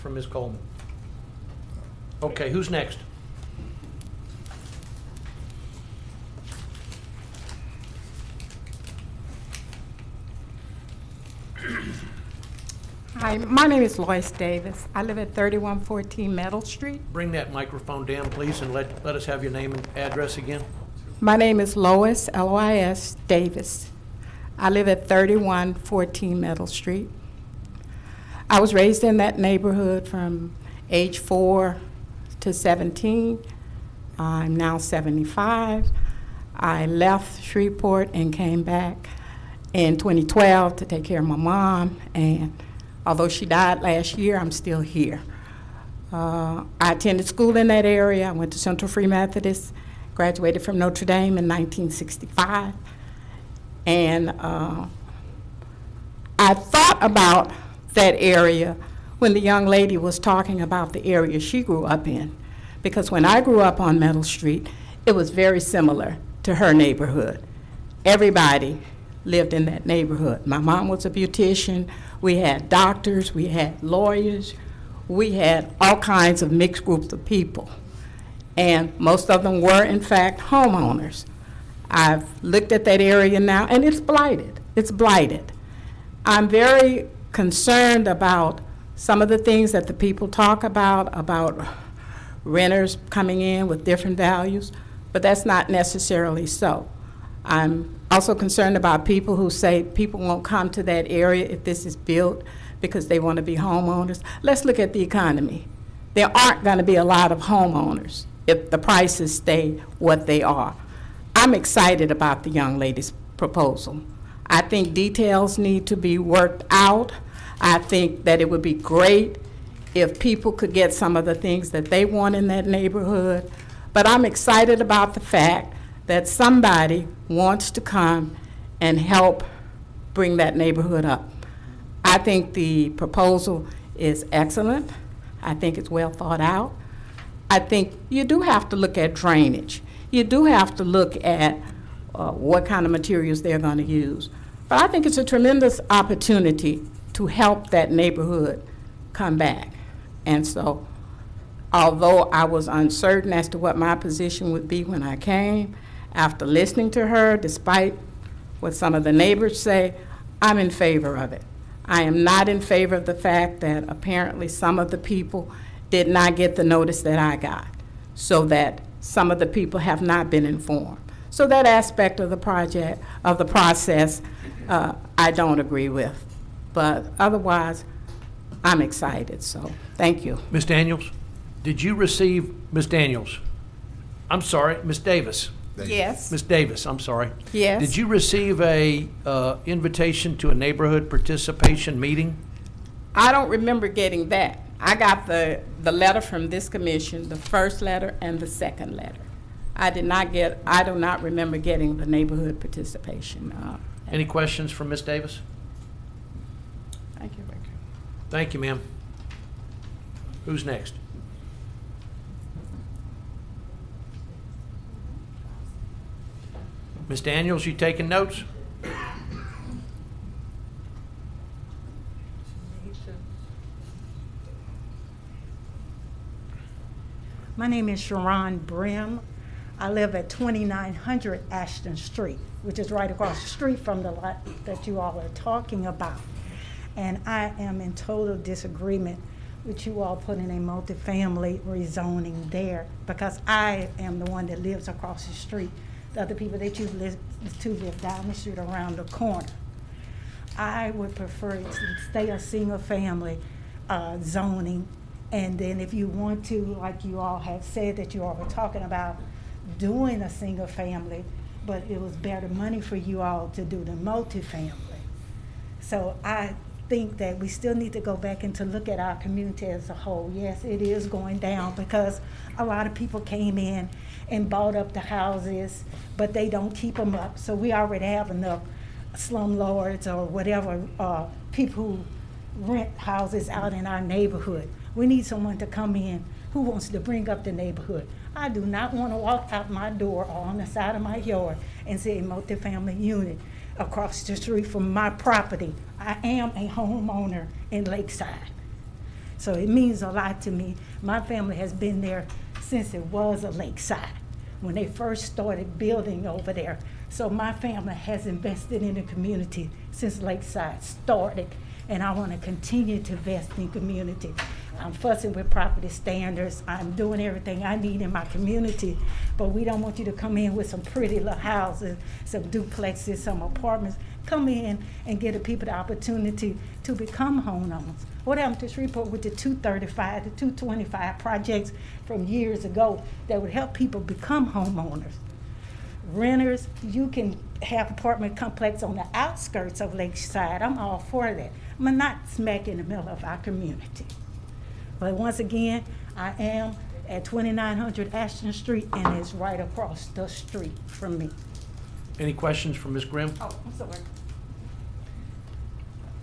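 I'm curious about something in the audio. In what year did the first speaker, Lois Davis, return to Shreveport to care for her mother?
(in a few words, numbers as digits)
2012.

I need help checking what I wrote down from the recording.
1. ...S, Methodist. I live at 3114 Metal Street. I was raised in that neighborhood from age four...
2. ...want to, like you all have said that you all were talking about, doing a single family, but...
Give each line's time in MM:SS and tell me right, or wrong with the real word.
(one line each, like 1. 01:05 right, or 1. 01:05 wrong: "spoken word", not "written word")
1. 00:22 wrong: "Davis", not "Methodist"
2. 04:16 right.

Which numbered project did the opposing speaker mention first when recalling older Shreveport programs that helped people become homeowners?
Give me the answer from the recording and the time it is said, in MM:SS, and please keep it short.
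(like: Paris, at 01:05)
235, at 05:29.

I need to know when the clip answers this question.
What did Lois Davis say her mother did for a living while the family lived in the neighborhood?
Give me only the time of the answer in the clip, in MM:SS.
01:11.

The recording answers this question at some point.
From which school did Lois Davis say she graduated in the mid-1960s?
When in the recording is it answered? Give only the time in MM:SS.
00:50.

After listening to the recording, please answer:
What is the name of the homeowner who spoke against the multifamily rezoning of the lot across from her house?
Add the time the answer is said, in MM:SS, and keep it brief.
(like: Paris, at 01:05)
Sharon Brim, at 03:47.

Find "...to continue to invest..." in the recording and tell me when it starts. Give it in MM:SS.
05:12.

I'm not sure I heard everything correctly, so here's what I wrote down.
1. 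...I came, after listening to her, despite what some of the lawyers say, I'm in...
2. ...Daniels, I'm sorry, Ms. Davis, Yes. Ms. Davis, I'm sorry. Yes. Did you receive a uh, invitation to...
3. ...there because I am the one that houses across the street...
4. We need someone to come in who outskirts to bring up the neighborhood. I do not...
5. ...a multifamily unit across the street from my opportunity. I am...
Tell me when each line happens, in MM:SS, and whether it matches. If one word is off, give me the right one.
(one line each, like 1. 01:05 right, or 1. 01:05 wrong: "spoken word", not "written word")
1. 02:35 wrong: "neighbors", not "lawyers"
2. 03:02 right
3. 04:02 wrong: "lives", not "houses"
4. 04:44 wrong: "wants", not "outskirts"
5. 04:52 wrong: "property", not "opportunity".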